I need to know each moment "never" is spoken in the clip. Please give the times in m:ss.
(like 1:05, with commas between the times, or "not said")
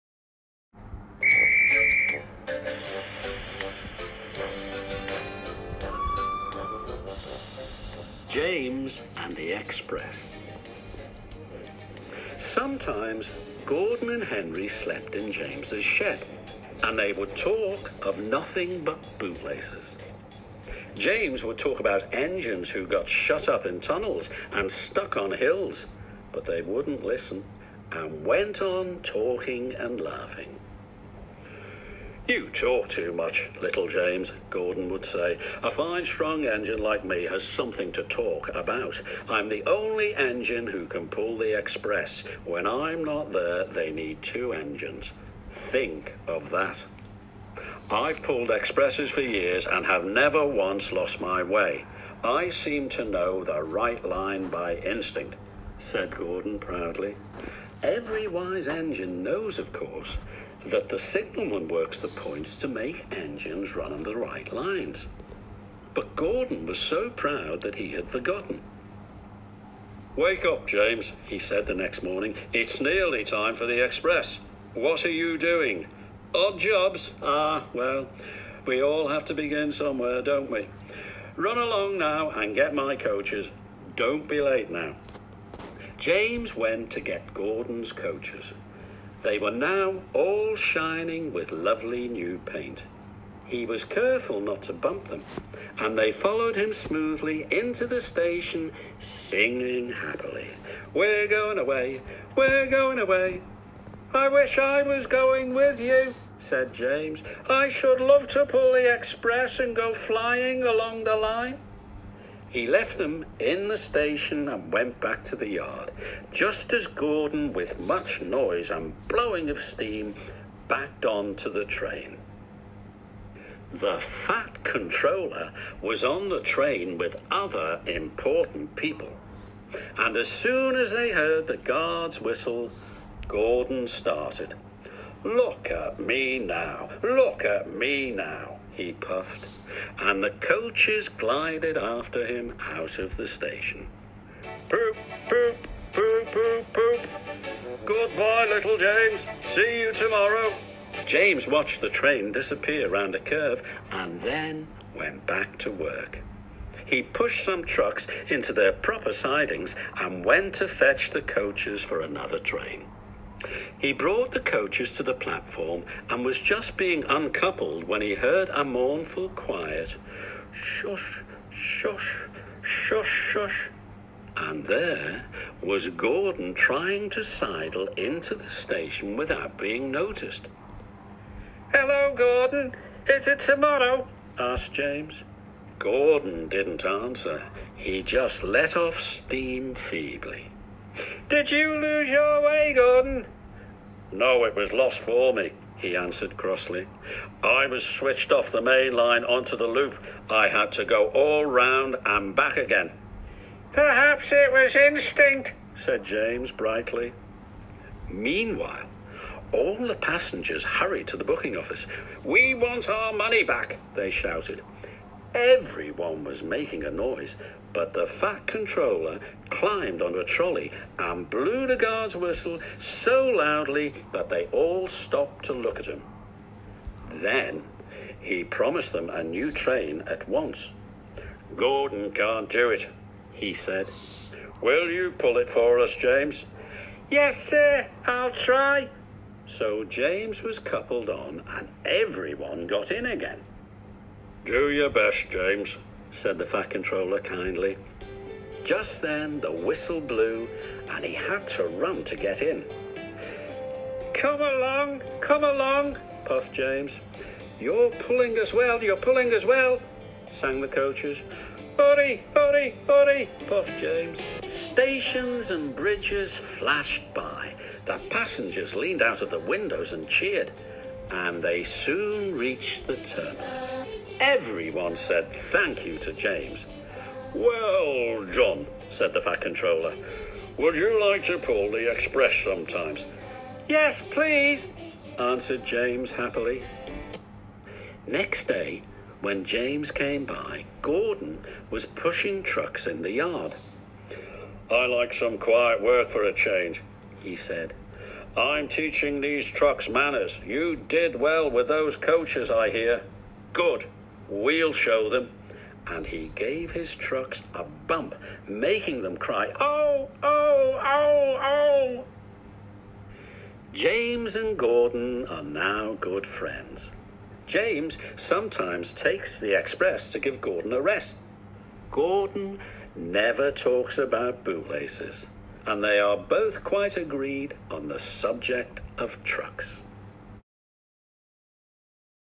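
0:50, 5:22.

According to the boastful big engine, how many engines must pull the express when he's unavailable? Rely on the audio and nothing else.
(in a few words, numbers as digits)
2.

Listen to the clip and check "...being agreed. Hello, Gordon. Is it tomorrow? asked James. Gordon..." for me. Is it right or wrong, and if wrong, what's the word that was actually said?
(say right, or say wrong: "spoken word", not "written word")
wrong: "noticed", not "agreed".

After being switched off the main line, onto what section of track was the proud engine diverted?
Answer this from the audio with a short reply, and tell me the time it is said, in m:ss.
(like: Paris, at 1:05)
The loop, at 3:19.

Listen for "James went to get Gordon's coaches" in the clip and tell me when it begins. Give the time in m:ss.
1:25.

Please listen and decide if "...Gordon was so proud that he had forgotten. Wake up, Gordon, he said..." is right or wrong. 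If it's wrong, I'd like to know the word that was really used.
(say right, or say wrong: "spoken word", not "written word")
wrong: "James", not "Gordon".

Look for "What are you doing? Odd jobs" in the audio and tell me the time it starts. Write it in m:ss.
1:14.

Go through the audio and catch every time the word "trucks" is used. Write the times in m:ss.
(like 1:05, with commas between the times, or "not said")
2:37, 4:52, 4:59, 5:06, 5:29.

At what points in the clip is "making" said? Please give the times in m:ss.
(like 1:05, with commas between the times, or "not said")
3:36, 5:08.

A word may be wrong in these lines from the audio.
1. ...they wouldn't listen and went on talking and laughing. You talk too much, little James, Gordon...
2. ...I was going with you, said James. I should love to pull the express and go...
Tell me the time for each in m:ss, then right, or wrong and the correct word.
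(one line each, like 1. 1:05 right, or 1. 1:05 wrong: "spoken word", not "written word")
1. 0:26 right
2. 1:44 right.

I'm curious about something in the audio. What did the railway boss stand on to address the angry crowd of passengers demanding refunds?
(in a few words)
A trolley.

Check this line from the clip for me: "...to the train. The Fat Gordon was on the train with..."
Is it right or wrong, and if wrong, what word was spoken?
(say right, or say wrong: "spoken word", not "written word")
wrong: "Controller", not "Gordon".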